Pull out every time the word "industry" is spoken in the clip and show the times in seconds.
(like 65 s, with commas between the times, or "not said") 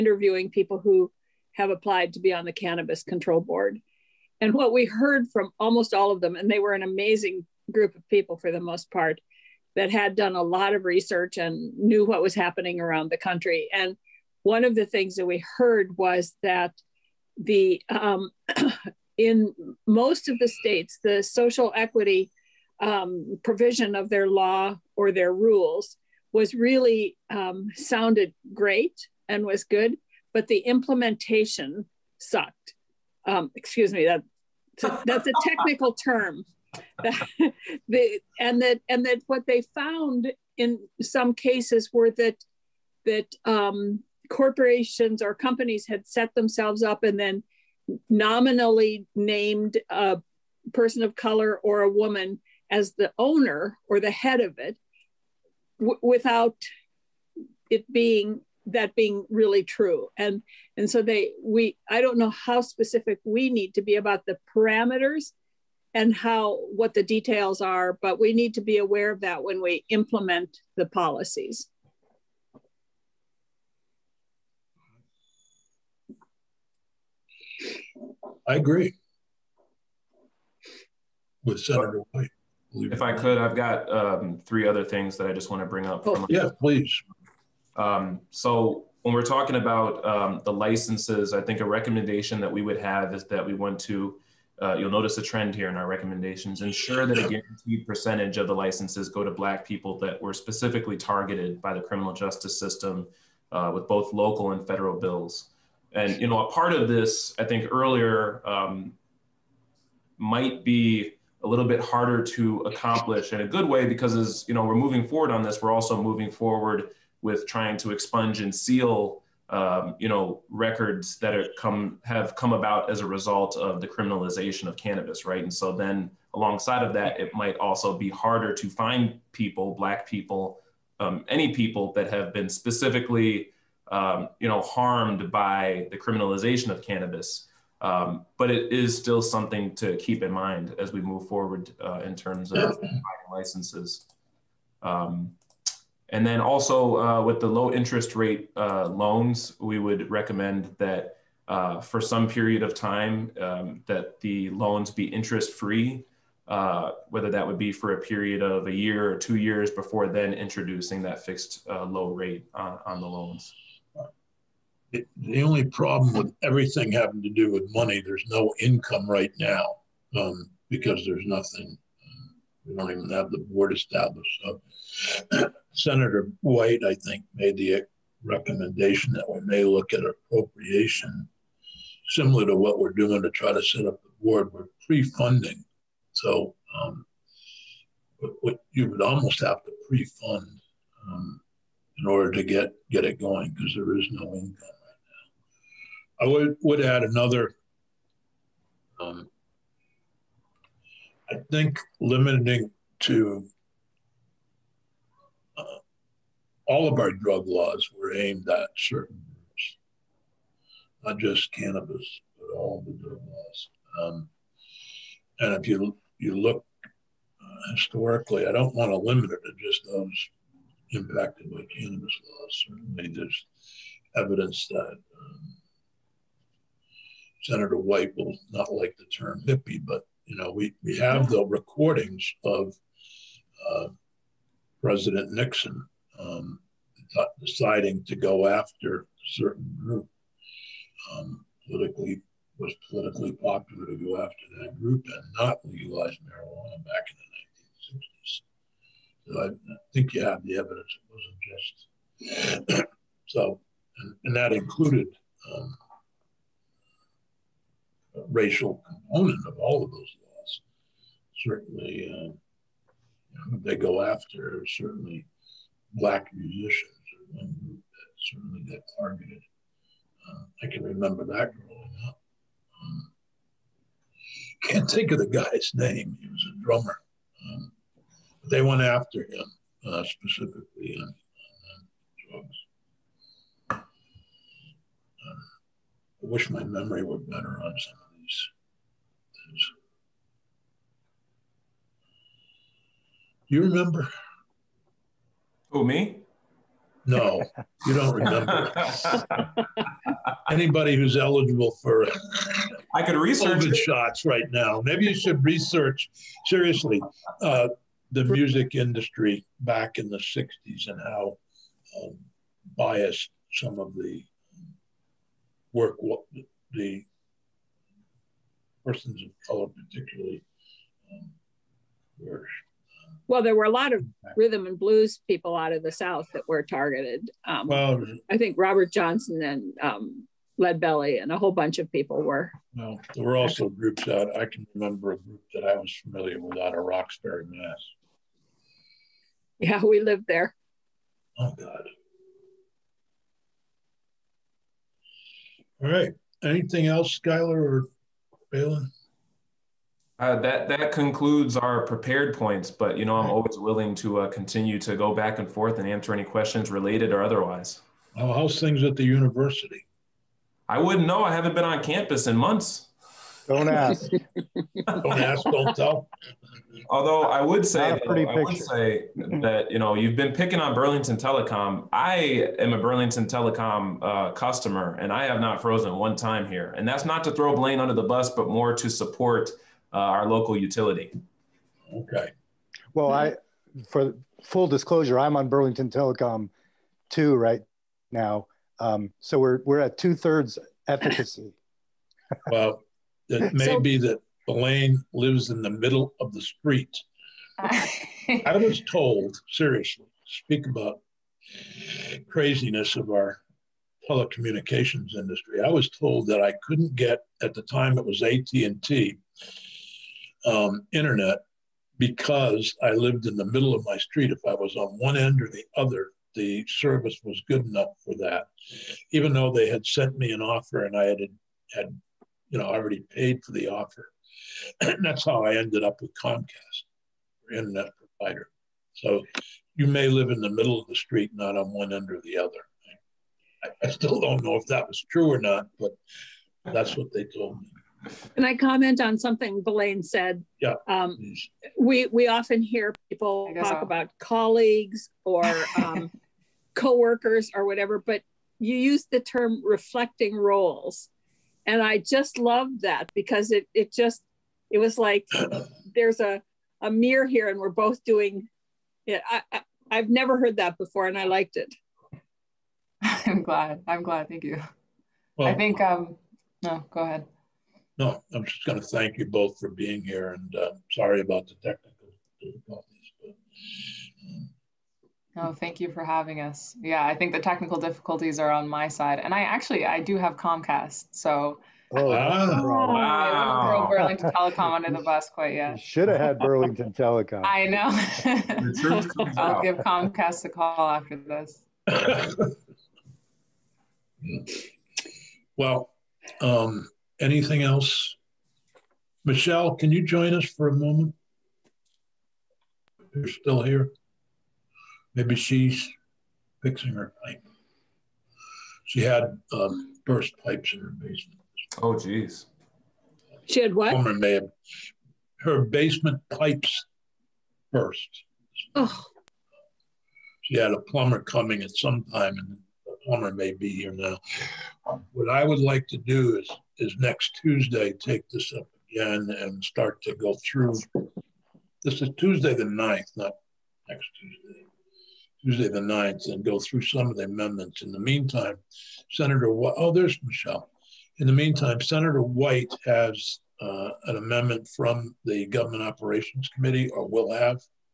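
308 s, 405 s.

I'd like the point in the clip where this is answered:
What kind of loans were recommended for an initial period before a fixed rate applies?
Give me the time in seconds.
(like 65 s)
155 s.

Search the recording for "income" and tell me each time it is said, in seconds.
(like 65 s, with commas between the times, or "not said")
168 s, 194 s.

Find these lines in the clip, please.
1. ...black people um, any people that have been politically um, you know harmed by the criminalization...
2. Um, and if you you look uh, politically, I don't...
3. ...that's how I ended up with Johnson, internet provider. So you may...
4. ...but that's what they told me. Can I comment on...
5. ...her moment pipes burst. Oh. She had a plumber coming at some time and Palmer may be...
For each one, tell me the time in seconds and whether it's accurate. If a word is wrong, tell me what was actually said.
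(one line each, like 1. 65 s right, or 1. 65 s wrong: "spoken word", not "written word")
1. 129 s wrong: "specifically", not "politically"
2. 214 s wrong: "historically", not "politically"
3. 425 s wrong: "Comcast", not "Johnson"
4. 435 s right
5. 515 s wrong: "basement", not "moment".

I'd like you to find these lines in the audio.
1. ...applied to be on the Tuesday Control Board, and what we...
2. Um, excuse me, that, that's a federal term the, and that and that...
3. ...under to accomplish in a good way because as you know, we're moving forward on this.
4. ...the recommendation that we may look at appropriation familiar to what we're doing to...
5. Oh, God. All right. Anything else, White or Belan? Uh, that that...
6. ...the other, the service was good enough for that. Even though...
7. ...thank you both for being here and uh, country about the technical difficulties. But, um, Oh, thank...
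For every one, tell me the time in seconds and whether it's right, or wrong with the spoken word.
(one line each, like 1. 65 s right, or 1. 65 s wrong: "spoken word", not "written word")
1. 1 s wrong: "Cannabis", not "Tuesday"
2. 33 s wrong: "technical", not "federal"
3. 111 s wrong: "harder", not "under"
4. 177 s wrong: "similar", not "familiar"
5. 341 s wrong: "Skylar", not "White"
6. 415 s right
7. 468 s wrong: "sorry", not "country".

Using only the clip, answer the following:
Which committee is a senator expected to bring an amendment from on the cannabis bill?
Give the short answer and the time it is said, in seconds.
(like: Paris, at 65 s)
Government Operations Committee, at 545 s.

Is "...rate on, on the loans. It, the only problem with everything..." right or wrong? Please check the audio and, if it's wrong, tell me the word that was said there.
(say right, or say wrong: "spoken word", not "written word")
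right.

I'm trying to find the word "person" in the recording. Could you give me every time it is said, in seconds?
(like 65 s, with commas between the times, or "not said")
50 s, 318 s.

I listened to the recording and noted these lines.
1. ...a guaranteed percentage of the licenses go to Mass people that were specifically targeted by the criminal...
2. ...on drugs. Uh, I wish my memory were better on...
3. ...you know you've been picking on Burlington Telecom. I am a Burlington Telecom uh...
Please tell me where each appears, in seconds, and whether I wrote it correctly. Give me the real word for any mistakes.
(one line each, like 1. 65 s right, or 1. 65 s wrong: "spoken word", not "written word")
1. 97 s wrong: "Black", not "Mass"
2. 281 s right
3. 369 s right.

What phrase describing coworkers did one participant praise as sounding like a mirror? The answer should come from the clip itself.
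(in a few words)
reflecting roles.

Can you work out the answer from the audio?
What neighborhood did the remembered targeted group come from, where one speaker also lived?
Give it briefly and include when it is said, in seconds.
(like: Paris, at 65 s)
Roxbury, Mass., at 336 s.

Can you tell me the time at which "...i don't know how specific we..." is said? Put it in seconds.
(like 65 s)
61 s.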